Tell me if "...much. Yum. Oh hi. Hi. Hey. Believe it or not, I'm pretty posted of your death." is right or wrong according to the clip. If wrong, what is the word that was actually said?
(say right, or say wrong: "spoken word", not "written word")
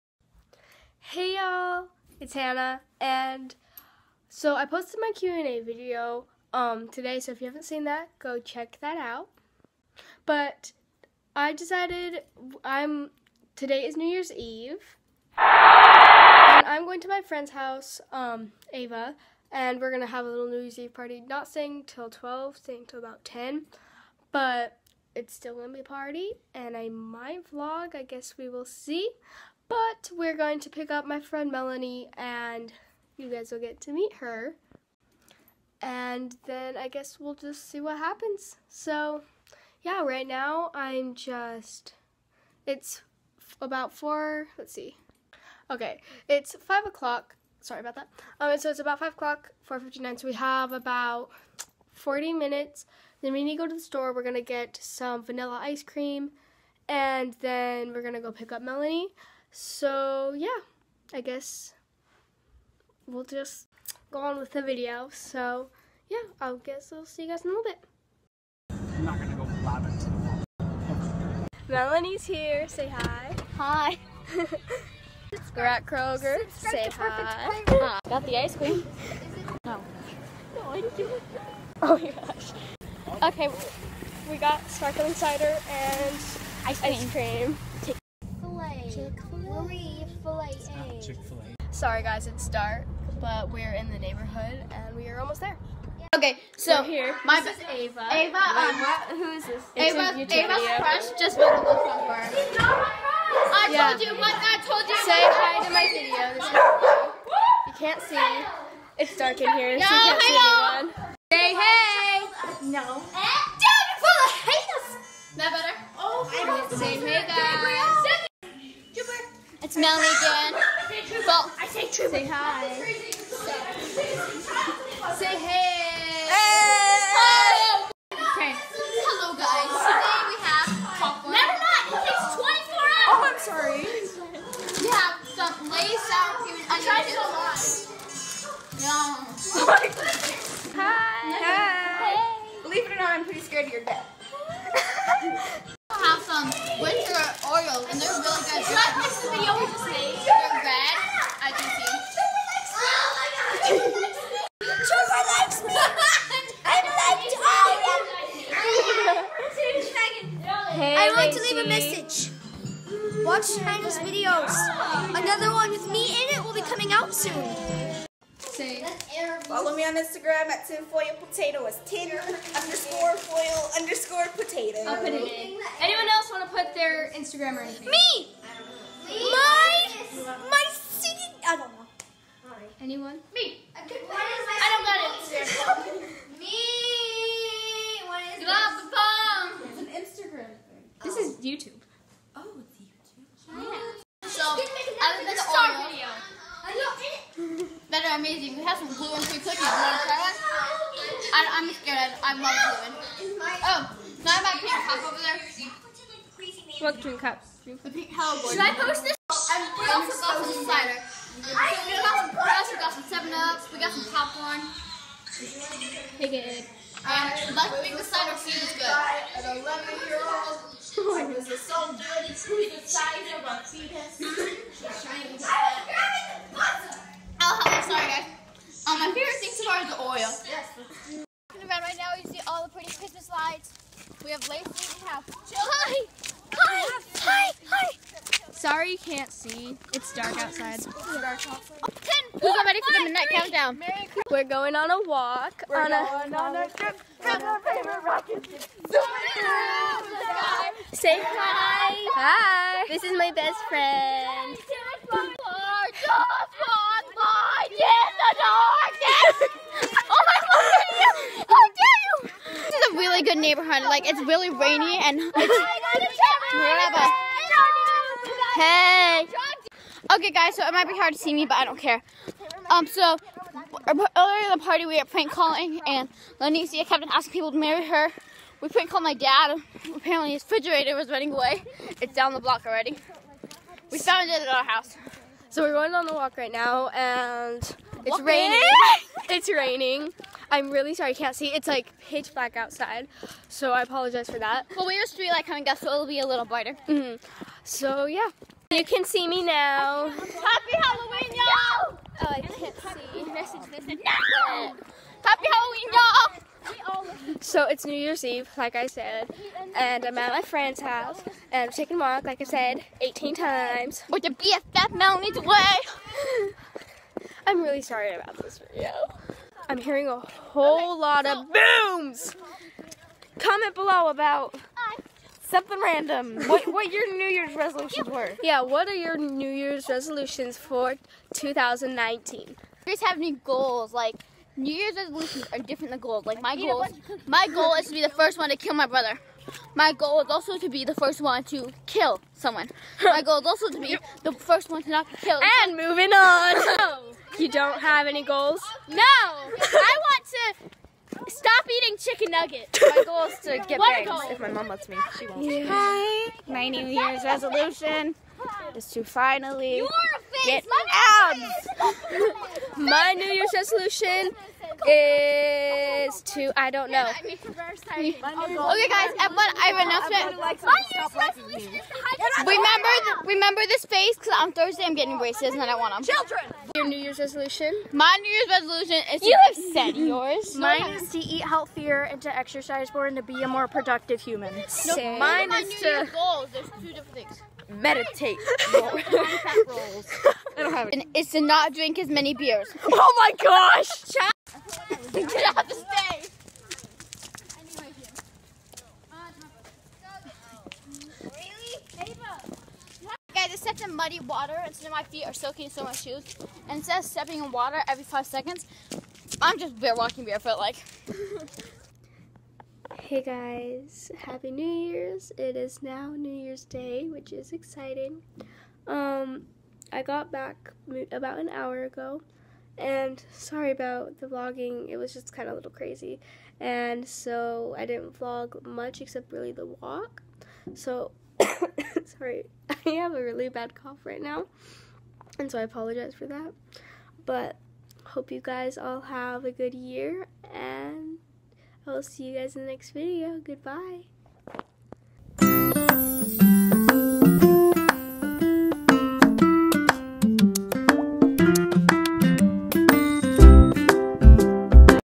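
wrong: "scared", not "posted".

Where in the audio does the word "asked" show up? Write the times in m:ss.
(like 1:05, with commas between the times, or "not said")
not said.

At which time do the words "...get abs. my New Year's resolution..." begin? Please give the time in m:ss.
6:00.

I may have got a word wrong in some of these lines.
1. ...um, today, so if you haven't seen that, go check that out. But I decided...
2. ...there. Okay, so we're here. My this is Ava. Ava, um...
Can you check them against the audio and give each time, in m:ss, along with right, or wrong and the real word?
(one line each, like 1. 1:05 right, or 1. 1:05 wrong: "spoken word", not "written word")
1. 0:06 right
2. 1:35 right.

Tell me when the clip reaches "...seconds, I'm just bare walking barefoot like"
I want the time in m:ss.
6:48.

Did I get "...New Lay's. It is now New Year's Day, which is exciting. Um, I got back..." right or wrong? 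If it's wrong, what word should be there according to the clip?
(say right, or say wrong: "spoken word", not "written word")
wrong: "Year", not "Lay".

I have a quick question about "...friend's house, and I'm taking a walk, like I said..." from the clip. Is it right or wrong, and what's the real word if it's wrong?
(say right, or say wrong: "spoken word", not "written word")
right.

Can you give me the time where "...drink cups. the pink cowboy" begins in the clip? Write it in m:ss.
3:27.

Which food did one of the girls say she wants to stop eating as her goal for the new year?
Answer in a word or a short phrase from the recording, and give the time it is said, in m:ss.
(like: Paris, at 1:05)
chicken nuggets, at 5:51.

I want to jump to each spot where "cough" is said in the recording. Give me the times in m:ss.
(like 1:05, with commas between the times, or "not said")
7:13.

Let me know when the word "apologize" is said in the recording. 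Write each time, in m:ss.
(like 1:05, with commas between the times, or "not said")
4:53, 7:15.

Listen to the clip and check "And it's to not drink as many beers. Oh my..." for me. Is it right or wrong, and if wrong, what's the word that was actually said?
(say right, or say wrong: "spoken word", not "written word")
right.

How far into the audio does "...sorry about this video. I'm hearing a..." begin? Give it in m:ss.
5:17.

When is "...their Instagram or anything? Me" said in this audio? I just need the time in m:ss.
2:56.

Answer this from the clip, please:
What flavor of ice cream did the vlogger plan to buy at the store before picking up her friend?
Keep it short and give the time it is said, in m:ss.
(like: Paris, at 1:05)
vanilla, at 0:55.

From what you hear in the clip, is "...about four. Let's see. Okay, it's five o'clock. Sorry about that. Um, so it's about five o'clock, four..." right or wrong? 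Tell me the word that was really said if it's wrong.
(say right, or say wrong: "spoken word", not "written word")
right.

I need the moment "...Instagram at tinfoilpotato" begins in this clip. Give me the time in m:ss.
2:49.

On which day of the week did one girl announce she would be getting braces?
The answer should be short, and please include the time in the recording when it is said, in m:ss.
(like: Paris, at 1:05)
Thursday, at 6:14.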